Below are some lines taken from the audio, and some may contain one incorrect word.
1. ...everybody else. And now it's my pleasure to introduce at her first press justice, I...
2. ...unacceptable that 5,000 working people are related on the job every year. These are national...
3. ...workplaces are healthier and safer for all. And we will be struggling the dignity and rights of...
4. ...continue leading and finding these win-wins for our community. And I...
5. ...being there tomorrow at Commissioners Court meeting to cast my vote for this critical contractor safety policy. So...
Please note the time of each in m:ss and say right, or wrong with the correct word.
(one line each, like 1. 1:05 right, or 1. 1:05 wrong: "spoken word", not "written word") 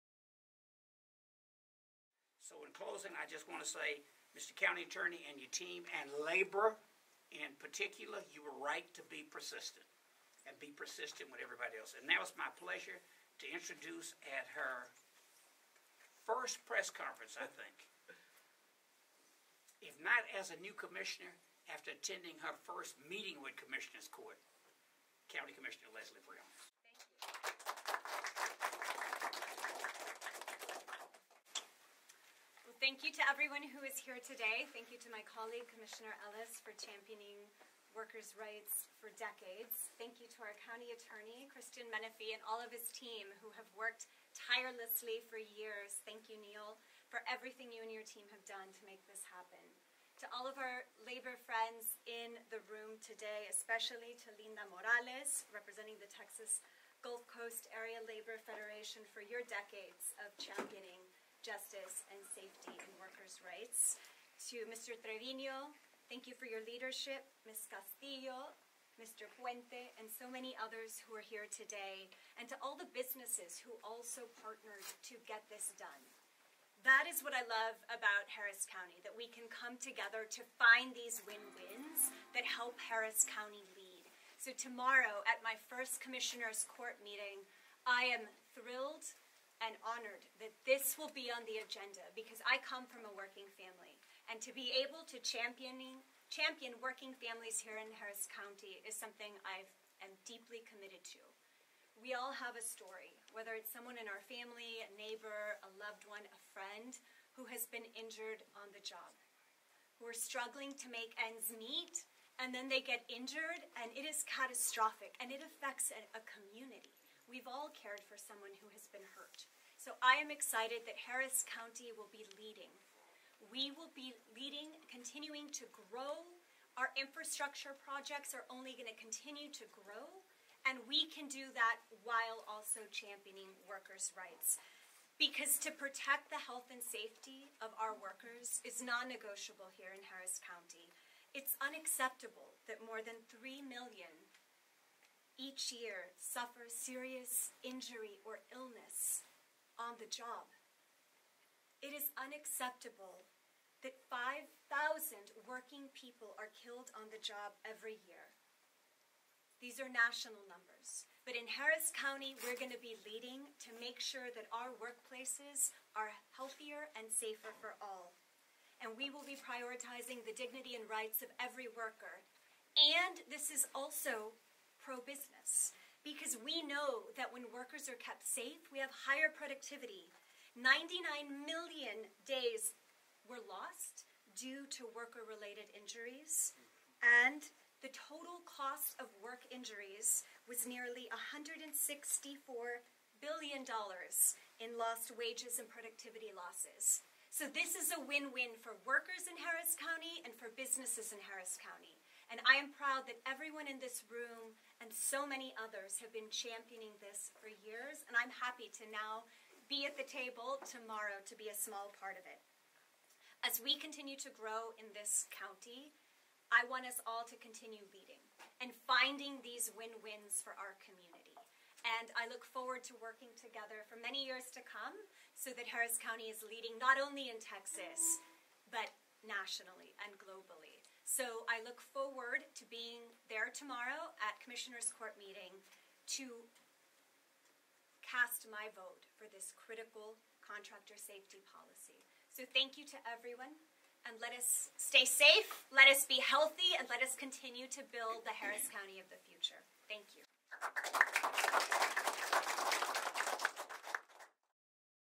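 1. 0:11 wrong: "conference", not "justice"
2. 2:32 wrong: "killed", not "related"
3. 2:44 wrong: "prioritizing", not "struggling"
4. 3:37 right
5. 3:52 right.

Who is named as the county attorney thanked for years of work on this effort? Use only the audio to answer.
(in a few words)
Christian Menefee.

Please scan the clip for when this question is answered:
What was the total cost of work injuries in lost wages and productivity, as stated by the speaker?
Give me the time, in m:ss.
3:11.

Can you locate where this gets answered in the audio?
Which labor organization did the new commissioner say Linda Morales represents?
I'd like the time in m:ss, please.
0:56.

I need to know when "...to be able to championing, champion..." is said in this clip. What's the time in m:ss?
1:34.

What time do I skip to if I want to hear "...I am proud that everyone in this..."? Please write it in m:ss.
3:22.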